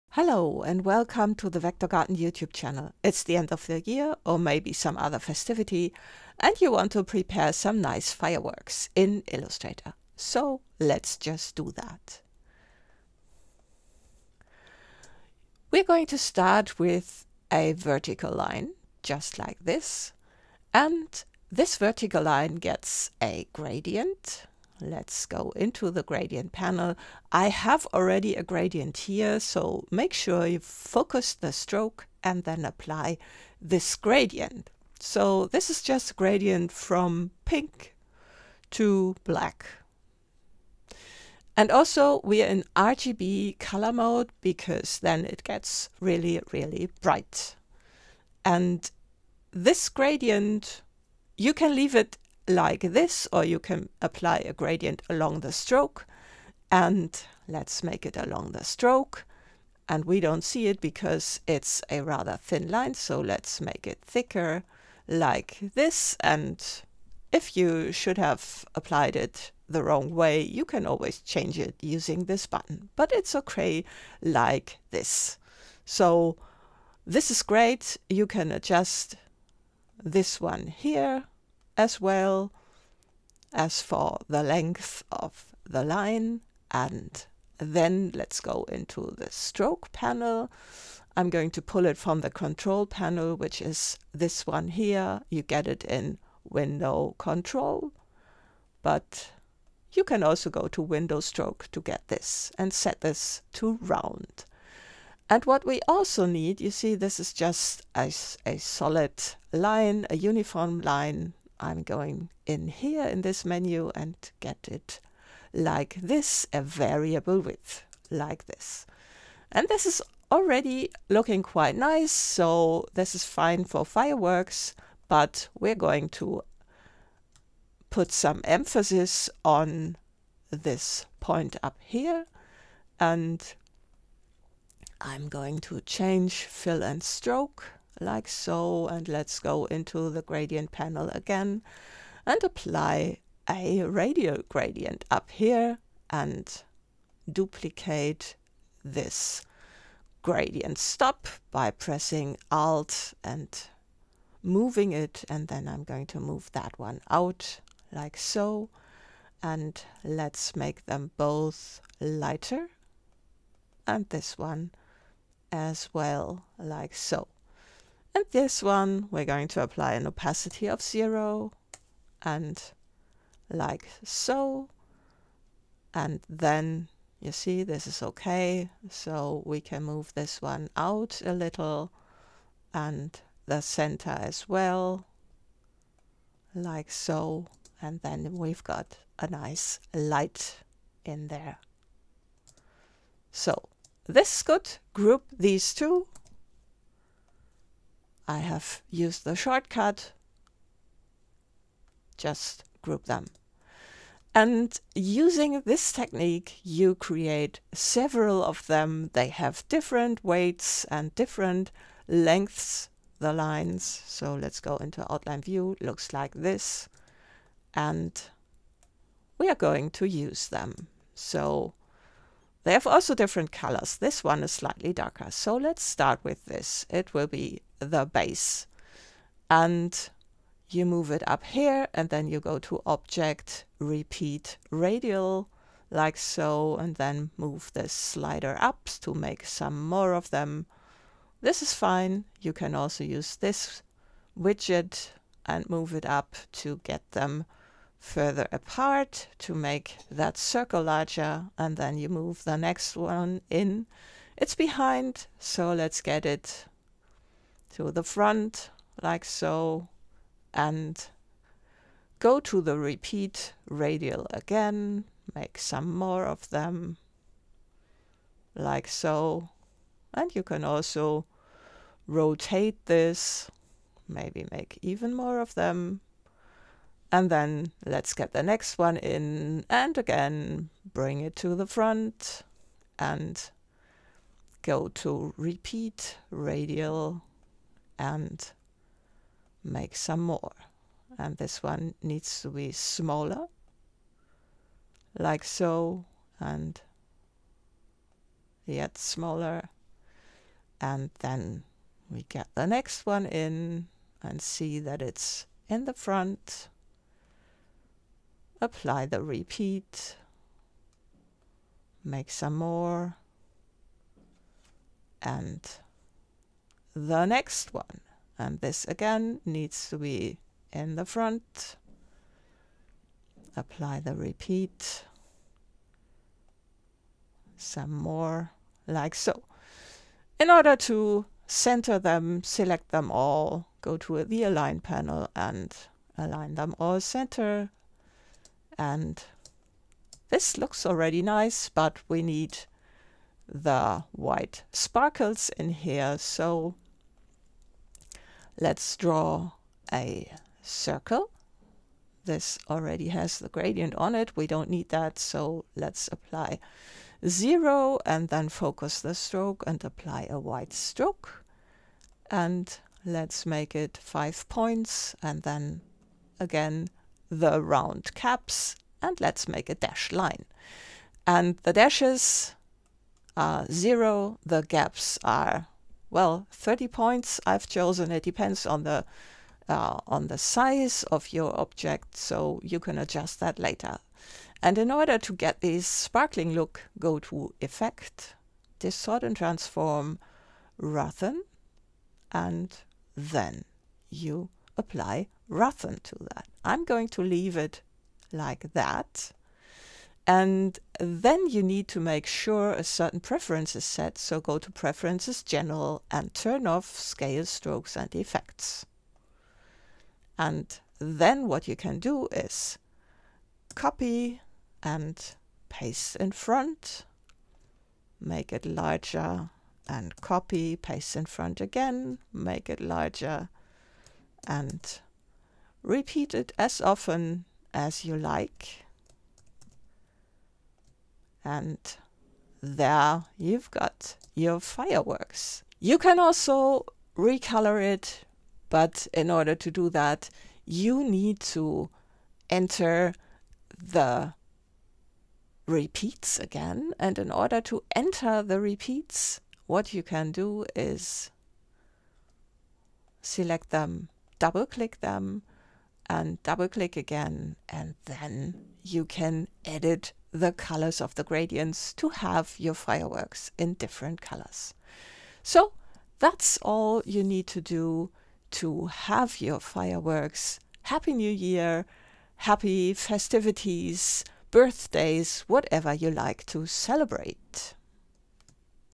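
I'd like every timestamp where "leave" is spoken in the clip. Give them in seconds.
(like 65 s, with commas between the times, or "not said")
51 s, 397 s.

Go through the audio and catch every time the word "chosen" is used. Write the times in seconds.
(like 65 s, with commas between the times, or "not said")
377 s.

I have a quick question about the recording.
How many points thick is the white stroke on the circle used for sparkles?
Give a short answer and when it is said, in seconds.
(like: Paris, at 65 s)
5, at 363 s.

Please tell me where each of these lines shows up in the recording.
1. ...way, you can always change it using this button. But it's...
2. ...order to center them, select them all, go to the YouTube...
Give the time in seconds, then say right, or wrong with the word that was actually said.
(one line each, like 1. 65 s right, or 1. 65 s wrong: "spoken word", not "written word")
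1. 70 s right
2. 330 s wrong: "Align", not "YouTube".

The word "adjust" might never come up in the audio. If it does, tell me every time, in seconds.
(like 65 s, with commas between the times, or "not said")
78 s, 382 s.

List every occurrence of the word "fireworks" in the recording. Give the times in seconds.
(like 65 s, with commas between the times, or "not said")
8 s, 123 s, 434 s, 462 s, 469 s.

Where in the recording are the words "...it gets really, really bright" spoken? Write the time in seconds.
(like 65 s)
45 s.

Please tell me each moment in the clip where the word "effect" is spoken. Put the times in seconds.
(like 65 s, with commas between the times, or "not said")
387 s, 408 s.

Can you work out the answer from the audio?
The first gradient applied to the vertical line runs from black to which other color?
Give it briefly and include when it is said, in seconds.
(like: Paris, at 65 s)
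Pink, at 37 s.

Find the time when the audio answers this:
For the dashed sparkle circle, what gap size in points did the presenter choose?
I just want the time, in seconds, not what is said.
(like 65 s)
376 s.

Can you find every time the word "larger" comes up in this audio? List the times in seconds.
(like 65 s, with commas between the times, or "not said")
250 s, 418 s, 422 s.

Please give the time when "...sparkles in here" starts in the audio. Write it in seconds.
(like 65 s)
344 s.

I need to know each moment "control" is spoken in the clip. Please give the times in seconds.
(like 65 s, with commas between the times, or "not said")
92 s, 97 s.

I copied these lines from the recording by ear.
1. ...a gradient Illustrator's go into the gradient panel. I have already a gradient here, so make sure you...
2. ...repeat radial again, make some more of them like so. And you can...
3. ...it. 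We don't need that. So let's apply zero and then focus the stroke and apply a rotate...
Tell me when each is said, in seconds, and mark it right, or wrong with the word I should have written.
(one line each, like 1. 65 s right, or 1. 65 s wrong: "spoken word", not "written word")
1. 23 s wrong: "Let", not "Illustrator"
2. 262 s right
3. 354 s wrong: "white", not "rotate".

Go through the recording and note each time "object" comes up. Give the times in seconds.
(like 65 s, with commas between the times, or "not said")
232 s, 381 s.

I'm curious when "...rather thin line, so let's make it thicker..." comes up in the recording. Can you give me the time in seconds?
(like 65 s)
62 s.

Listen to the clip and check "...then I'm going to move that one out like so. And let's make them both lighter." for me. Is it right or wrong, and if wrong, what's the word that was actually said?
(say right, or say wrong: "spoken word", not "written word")
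right.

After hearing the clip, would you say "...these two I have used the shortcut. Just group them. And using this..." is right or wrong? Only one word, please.
right.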